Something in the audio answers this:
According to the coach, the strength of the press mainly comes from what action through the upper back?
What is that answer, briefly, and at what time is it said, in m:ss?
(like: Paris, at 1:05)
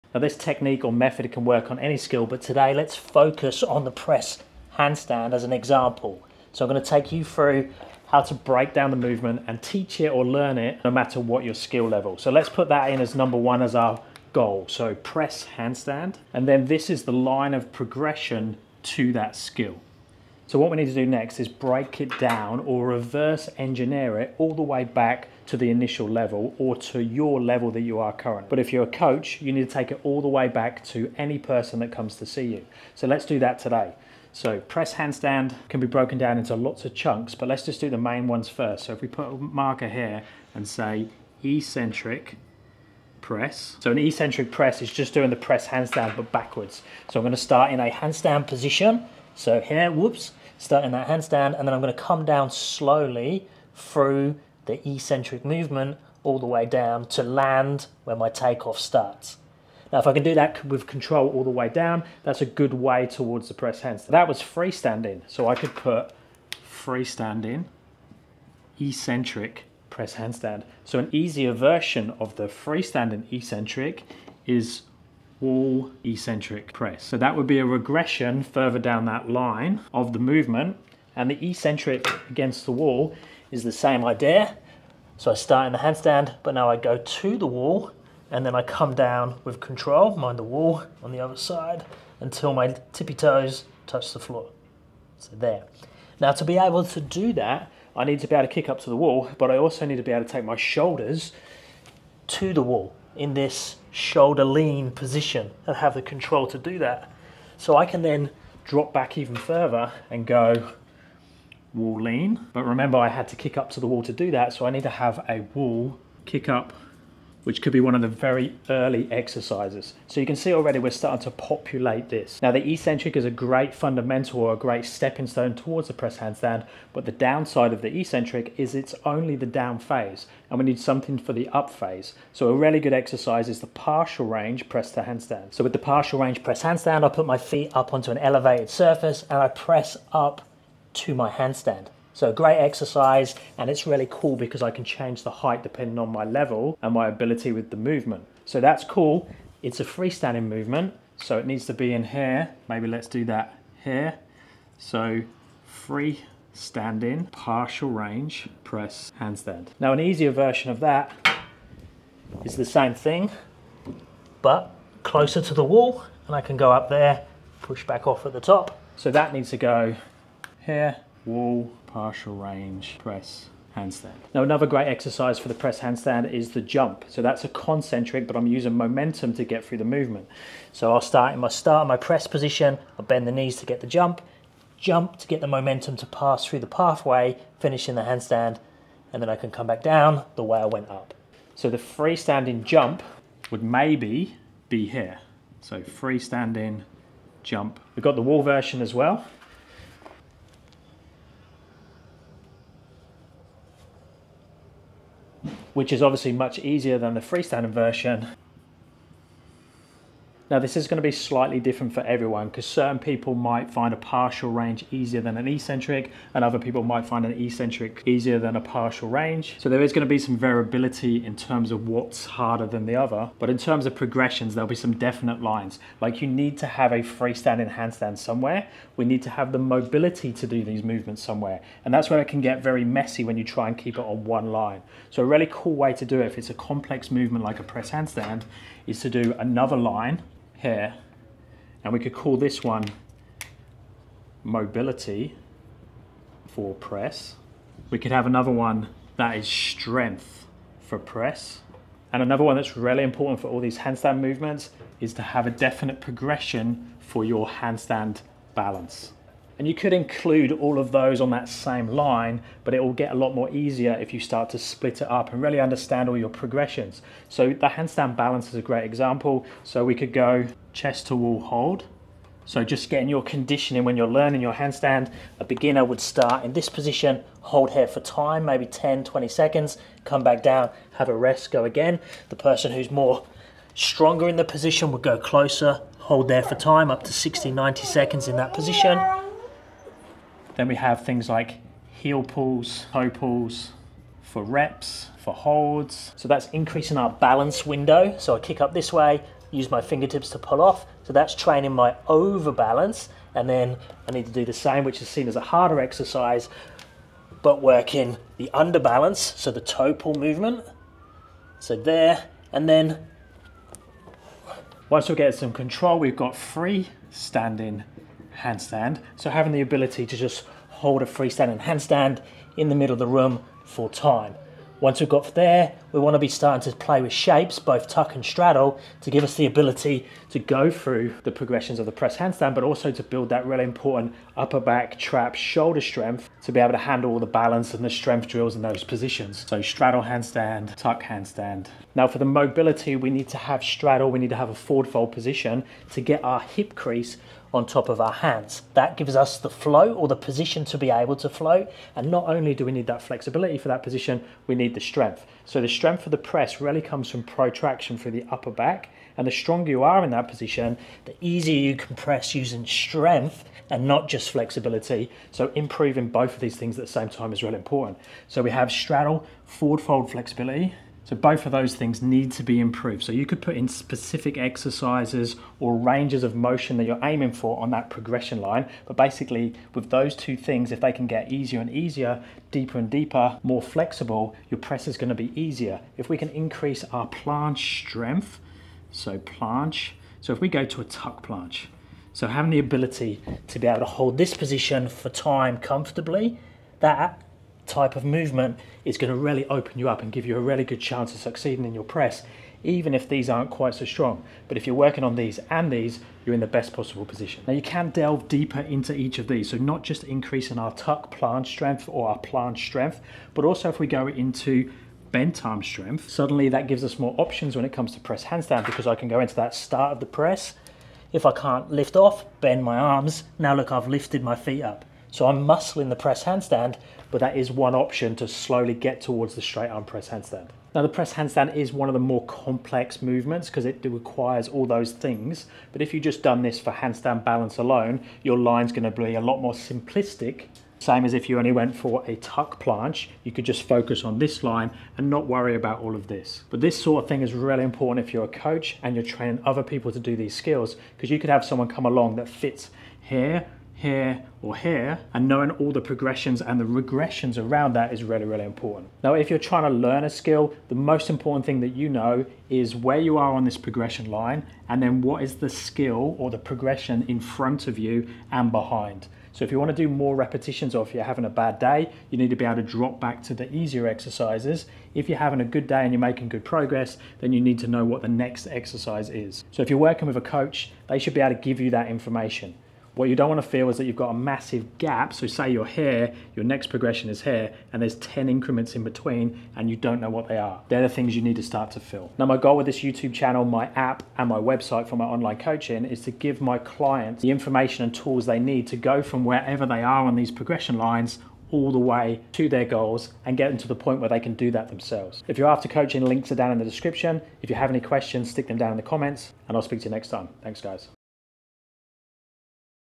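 protraction, at 5:57.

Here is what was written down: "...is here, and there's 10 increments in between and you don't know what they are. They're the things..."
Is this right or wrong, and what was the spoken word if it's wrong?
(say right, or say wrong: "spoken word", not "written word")
right.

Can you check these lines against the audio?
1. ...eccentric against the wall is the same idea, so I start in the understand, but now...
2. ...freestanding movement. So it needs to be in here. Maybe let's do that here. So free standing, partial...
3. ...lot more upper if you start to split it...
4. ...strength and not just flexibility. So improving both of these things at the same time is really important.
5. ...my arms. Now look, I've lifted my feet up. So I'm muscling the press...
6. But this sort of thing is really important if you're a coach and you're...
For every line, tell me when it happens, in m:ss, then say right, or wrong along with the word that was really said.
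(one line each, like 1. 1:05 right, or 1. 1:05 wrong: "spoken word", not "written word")
1. 1:21 wrong: "handstand", not "understand"
2. 2:29 right
3. 4:23 wrong: "easier", not "upper"
4. 6:02 right
5. 7:02 right
6. 7:26 right.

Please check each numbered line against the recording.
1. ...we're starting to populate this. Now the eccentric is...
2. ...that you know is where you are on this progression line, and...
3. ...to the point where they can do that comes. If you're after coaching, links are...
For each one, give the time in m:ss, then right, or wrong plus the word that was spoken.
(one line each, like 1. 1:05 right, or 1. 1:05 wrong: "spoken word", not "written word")
1. 2:00 right
2. 7:41 right
3. 8:23 wrong: "themselves", not "comes".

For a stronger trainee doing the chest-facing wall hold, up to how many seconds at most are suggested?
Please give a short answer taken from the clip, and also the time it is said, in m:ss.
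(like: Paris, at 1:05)
90 seconds, at 4:47.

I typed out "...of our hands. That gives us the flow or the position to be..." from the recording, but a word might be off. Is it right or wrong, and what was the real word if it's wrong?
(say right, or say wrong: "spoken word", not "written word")
right.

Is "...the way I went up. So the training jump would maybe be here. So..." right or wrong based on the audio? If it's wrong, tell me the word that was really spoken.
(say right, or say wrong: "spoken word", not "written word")
wrong: "freestanding", not "training".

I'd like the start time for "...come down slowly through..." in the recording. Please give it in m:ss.
0:51.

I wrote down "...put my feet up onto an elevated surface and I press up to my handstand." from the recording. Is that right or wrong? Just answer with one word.
right.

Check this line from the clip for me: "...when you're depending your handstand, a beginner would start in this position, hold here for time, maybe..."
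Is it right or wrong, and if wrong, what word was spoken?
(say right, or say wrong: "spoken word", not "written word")
wrong: "learning", not "depending".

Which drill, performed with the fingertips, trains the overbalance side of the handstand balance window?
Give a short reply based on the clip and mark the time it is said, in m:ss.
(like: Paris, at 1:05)
heel pulls, at 4:51.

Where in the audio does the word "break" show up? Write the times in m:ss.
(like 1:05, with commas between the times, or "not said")
0:08, 0:21.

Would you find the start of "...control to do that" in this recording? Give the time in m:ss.
1:46.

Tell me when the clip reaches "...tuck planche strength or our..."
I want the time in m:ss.
6:50.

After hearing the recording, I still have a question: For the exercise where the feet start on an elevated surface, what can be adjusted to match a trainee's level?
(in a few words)
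the height.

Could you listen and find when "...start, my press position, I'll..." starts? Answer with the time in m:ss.
3:01.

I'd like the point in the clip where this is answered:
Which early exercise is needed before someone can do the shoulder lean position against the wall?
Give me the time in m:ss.
1:55.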